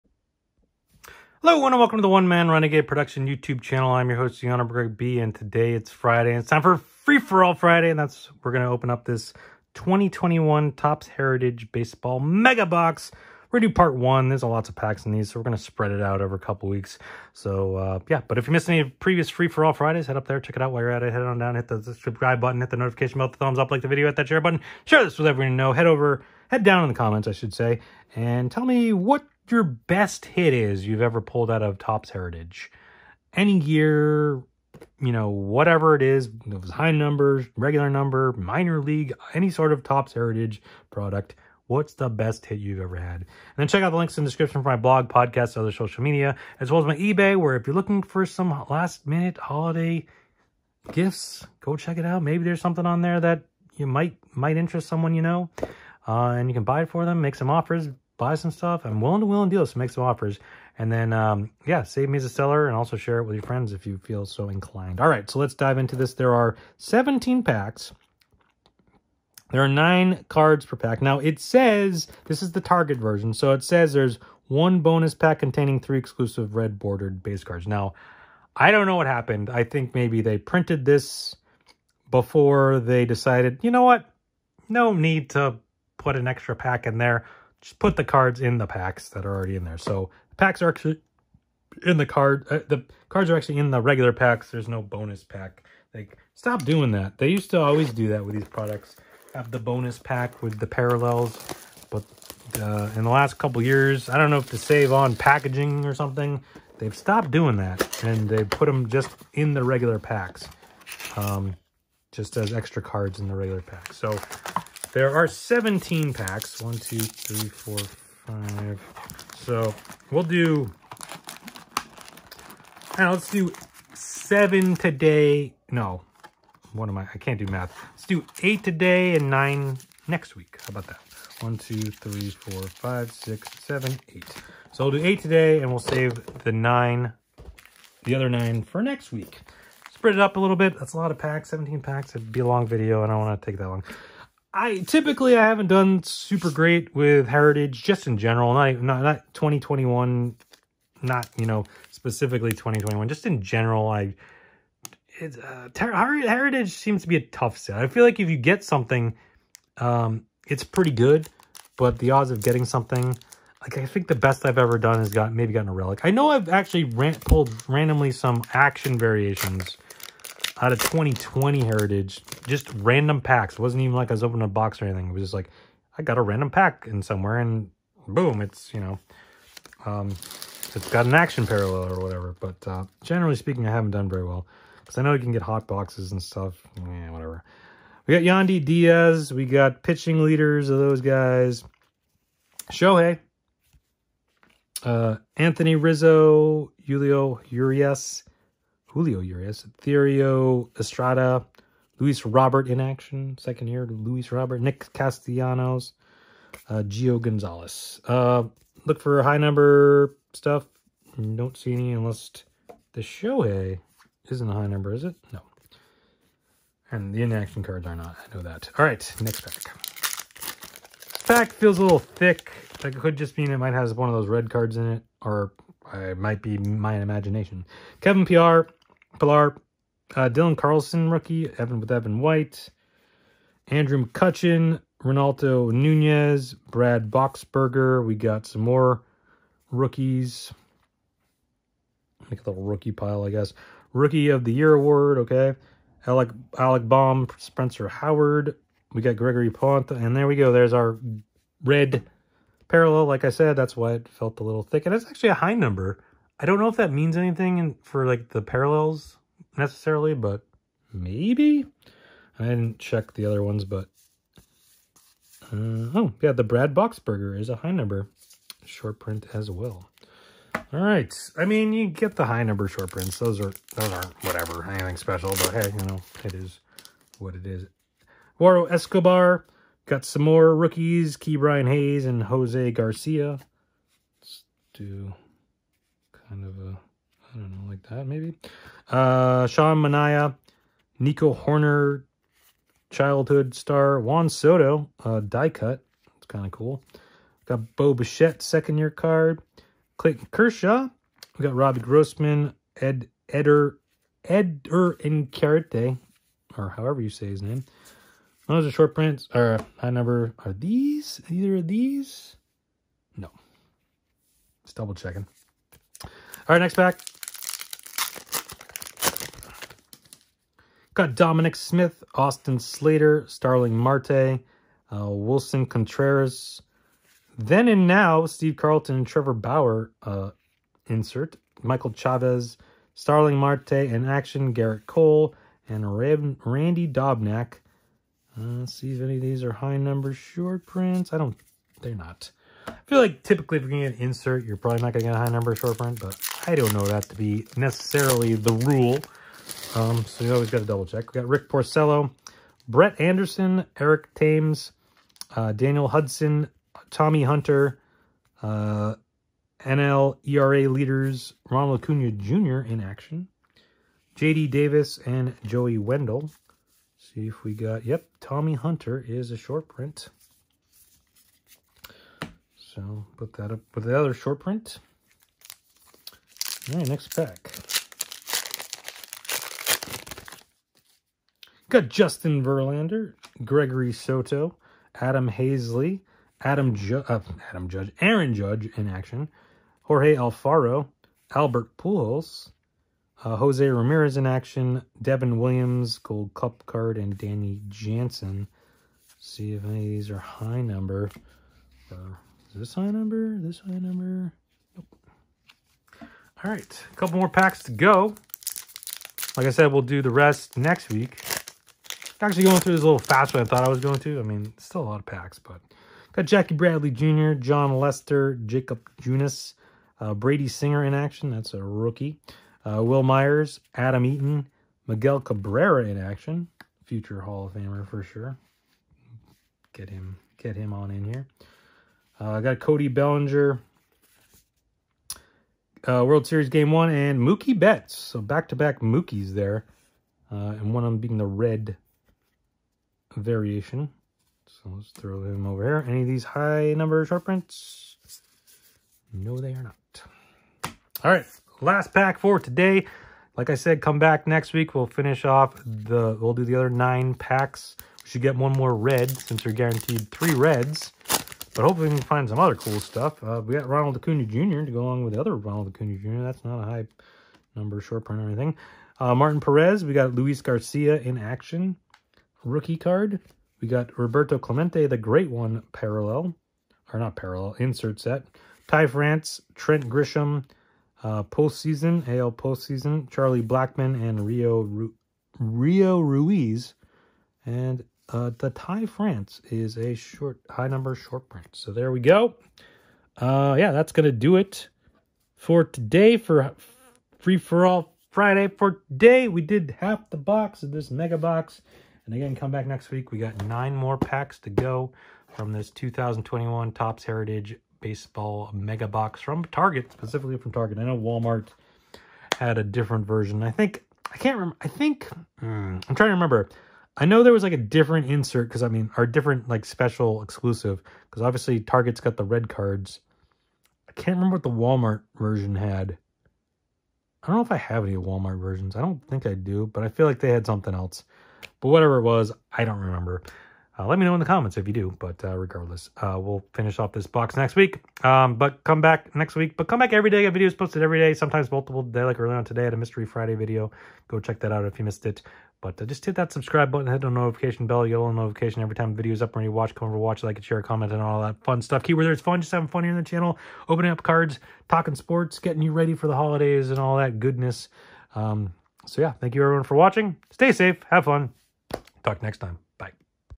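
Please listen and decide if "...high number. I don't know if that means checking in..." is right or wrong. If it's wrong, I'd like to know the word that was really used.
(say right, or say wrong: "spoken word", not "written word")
wrong: "anything", not "checking".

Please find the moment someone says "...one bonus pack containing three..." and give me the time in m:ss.
1:14.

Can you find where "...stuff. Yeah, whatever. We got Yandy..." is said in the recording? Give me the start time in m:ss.
3:06.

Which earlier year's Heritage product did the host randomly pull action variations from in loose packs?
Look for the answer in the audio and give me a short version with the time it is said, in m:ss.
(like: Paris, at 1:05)
2020, at 2:50.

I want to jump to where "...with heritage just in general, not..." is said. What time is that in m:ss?
2:26.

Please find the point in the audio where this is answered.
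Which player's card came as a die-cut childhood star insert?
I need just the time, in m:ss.
4:53.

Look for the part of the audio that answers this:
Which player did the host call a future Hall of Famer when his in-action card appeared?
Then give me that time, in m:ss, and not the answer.
7:04.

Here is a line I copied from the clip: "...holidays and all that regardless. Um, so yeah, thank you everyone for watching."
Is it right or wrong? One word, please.
wrong.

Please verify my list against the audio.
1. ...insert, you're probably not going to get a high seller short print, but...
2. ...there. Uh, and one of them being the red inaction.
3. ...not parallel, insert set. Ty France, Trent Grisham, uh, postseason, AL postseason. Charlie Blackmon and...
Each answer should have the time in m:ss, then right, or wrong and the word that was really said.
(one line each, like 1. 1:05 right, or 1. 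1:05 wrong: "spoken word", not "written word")
1. 5:44 wrong: "number", not "seller"
2. 7:19 wrong: "variation", not "inaction"
3. 7:56 right.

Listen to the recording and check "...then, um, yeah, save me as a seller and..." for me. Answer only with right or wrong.
right.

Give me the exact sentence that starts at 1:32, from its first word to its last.
Uh, the cards are actually in the regular packs.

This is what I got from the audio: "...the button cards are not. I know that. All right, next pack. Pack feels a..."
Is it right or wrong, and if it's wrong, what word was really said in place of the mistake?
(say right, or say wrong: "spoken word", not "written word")
wrong: "inaction", not "button".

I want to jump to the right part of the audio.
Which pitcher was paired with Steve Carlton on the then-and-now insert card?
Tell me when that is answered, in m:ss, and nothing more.
5:29.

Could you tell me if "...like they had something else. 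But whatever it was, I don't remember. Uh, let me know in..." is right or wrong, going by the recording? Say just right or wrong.
right.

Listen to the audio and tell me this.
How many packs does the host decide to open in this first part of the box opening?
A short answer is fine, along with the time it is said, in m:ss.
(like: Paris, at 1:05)
8, at 2:07.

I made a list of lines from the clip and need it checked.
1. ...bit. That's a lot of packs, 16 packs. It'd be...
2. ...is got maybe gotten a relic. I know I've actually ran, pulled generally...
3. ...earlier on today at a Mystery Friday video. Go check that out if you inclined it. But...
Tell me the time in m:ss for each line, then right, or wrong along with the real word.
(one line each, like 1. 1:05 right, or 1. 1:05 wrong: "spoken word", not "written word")
1. 2:20 wrong: "17", not "16"
2. 2:45 wrong: "randomly", not "generally"
3. 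9:02 wrong: "missed", not "inclined".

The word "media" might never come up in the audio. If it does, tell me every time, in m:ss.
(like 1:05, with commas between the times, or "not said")
0:46.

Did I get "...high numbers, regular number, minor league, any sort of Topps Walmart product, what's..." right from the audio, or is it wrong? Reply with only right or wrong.
wrong.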